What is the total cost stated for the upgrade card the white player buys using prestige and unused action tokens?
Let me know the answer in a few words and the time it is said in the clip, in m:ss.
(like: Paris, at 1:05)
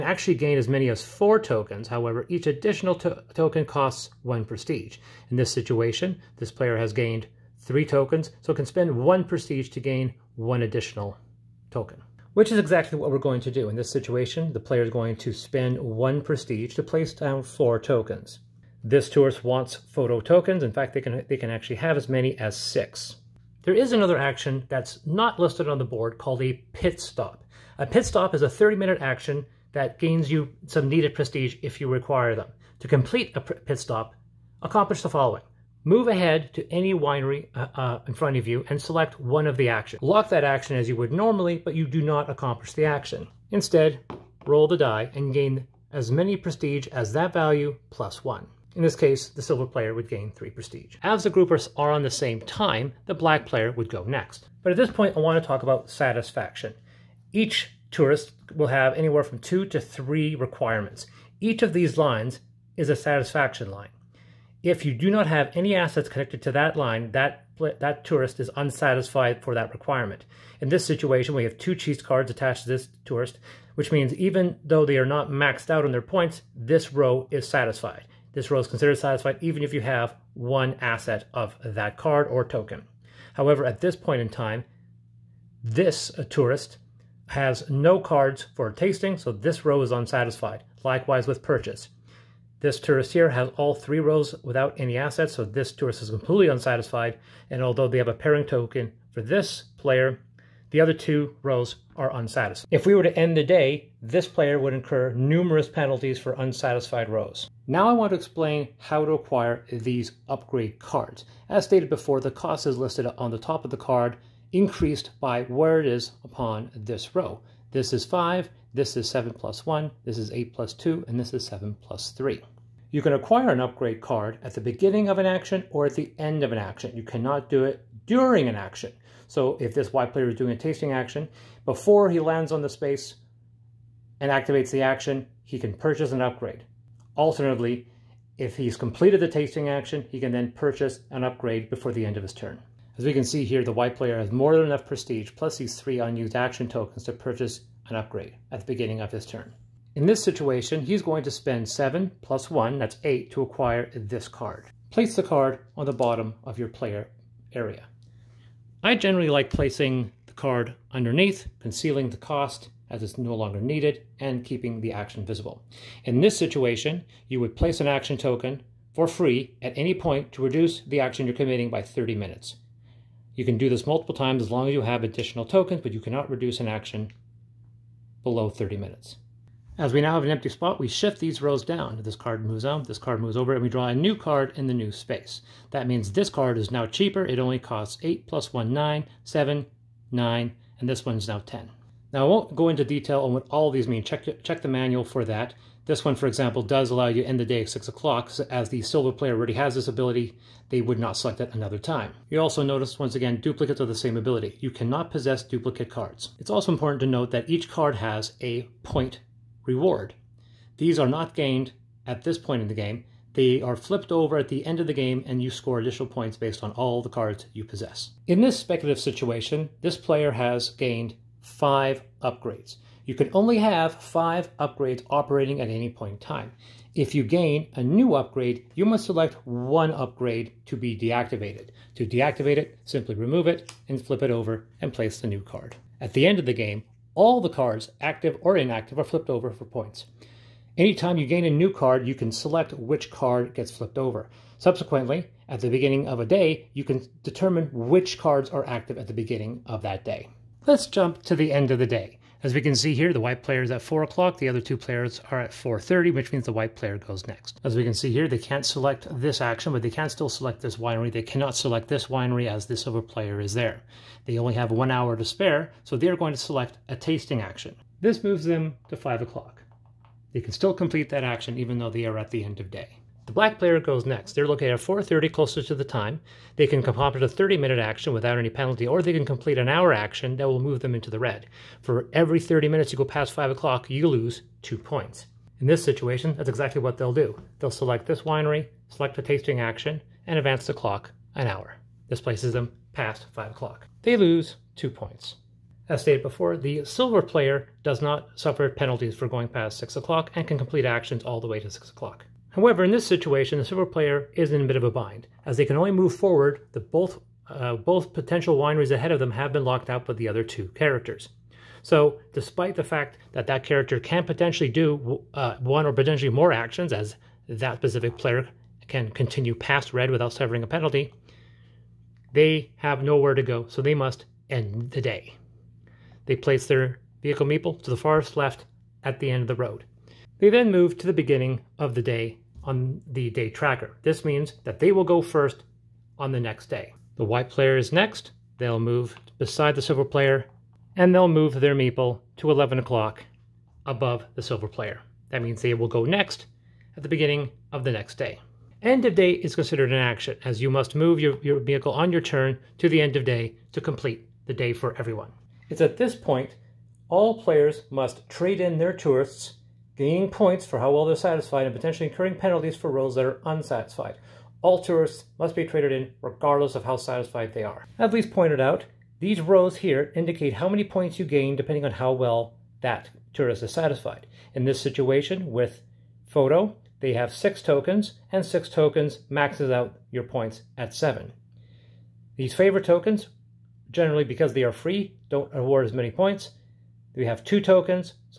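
8, at 2:32.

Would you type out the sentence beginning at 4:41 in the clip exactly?
For every 30 minutes you go past 5 o'clock, you lose 2 points.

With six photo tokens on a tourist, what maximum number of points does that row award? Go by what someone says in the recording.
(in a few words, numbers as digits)
7.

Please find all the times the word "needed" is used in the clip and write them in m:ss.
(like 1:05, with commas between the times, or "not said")
0:30, 2:43.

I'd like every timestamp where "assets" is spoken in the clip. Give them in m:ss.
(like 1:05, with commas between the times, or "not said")
1:05, 1:20, 1:34.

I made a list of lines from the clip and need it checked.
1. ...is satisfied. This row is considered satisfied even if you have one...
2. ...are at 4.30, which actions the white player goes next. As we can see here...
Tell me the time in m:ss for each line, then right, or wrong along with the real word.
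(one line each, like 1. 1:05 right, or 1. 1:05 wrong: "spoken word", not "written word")
1. 1:17 right
2. 4:15 wrong: "means", not "actions".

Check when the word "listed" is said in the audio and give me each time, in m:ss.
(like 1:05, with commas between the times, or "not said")
0:25, 1:52.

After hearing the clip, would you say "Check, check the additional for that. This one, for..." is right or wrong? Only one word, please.
wrong.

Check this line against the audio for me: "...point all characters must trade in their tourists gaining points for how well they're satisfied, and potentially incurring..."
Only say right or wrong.
wrong.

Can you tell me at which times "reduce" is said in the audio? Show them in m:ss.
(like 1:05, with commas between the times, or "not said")
2:50, 2:56.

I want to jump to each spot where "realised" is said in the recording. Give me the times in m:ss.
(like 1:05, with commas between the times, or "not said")
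not said.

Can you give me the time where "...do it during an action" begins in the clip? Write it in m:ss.
2:07.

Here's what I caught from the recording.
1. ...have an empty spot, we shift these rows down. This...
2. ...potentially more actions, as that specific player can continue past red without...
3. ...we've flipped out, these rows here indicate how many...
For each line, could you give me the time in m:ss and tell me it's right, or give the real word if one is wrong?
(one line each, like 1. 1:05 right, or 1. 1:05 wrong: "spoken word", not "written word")
1. 3:00 right
2. 5:15 right
3. 6:08 wrong: "pointed", not "flipped".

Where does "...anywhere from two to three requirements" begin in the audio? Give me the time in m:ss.
0:58.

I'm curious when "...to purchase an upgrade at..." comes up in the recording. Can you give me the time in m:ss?
2:27.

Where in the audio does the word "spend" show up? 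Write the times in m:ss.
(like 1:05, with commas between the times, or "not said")
0:08, 0:15, 2:31.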